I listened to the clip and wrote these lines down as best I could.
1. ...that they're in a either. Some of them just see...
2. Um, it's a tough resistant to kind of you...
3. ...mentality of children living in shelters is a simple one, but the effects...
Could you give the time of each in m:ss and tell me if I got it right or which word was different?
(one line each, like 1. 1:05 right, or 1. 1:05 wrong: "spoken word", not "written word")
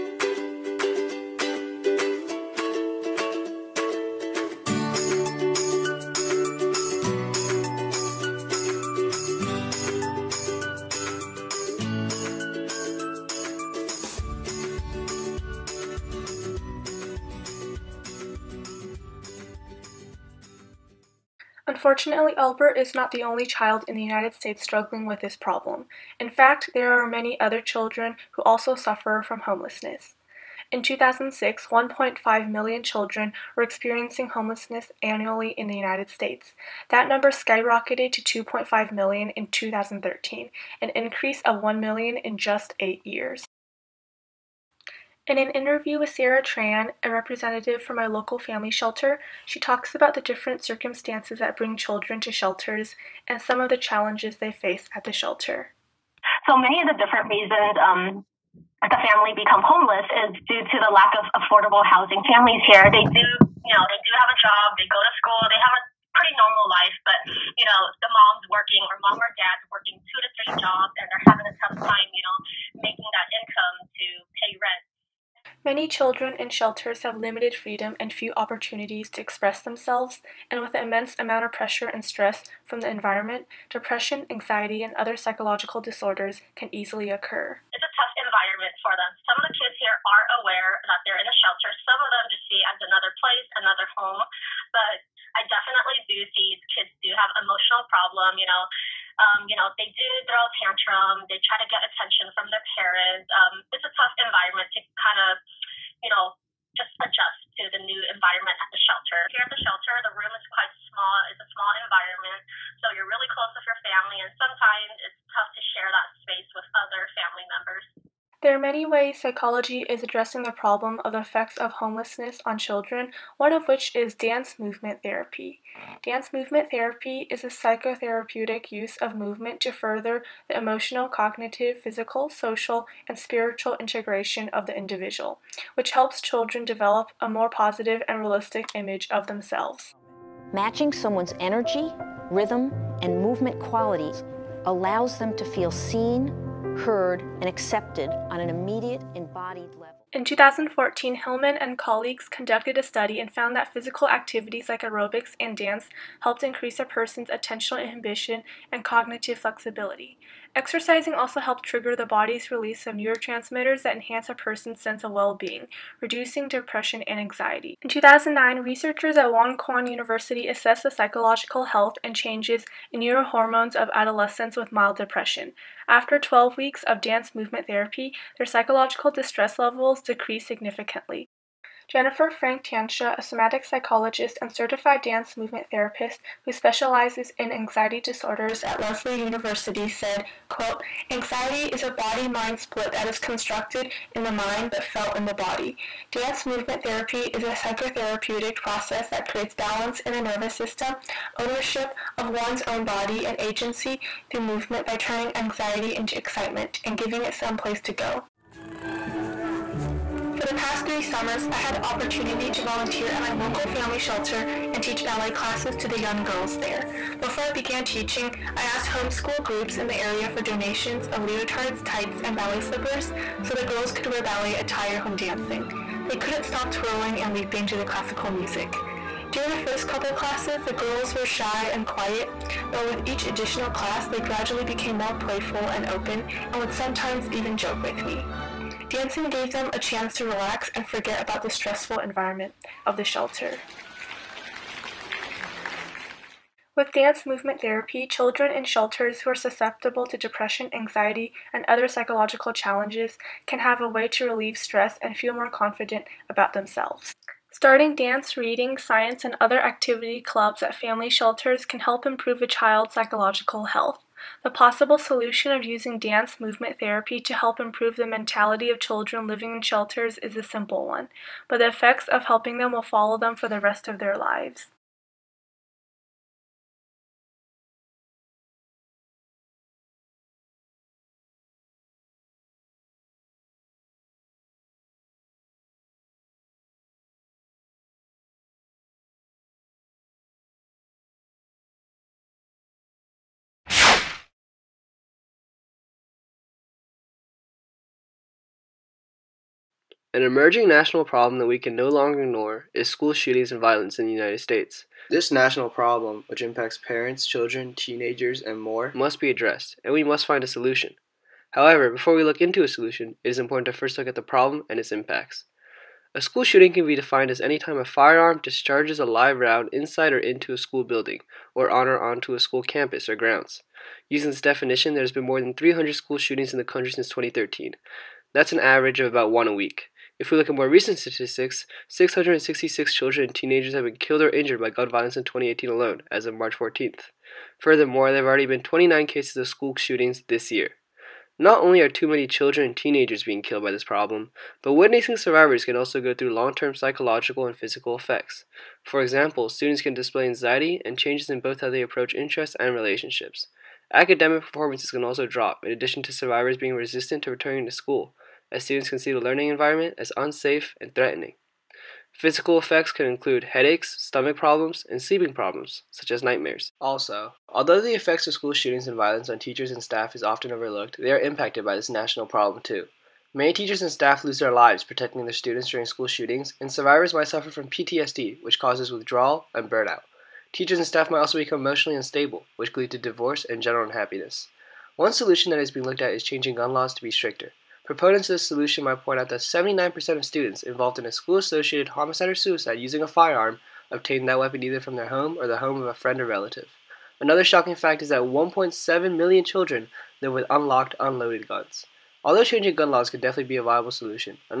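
1. 1:30 wrong: "shelter", not "either"
2. 1:43 wrong: "environment", not "resistant"
3. 4:28 right.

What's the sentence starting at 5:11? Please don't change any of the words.
However, before we look into a solution, it is important to first look at the problem and its impacts.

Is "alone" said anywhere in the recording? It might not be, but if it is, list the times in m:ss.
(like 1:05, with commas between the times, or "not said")
5:35.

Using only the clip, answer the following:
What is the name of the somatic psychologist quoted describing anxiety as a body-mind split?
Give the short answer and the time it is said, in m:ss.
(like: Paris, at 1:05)
Jennifer Frank Tantia, at 3:01.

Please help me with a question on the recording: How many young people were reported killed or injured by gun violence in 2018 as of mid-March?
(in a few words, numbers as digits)
666.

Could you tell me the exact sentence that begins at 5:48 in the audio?
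For example, students can display anxiety and changes in both how they approach interests and relationships.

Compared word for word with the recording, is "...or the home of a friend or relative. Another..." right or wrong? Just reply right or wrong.
right.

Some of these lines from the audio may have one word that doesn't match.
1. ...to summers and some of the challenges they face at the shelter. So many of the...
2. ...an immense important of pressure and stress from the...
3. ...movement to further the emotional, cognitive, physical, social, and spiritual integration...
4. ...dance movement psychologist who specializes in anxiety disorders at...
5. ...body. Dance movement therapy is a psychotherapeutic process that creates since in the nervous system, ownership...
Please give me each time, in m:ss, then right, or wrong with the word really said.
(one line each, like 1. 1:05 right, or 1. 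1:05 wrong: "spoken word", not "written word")
1. 0:52 wrong: "shelters", not "summers"
2. 1:20 wrong: "amount", not "important"
3. 2:09 right
4. 3:05 wrong: "therapist", not "psychologist"
5. 3:15 wrong: "balance", not "since".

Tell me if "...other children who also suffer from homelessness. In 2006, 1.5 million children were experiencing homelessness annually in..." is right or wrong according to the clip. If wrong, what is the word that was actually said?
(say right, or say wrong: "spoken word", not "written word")
right.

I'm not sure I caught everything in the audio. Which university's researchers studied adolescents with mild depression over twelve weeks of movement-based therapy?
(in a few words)
Wonkwang University.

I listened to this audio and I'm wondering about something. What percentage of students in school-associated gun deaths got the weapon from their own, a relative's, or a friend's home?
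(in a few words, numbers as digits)
79%.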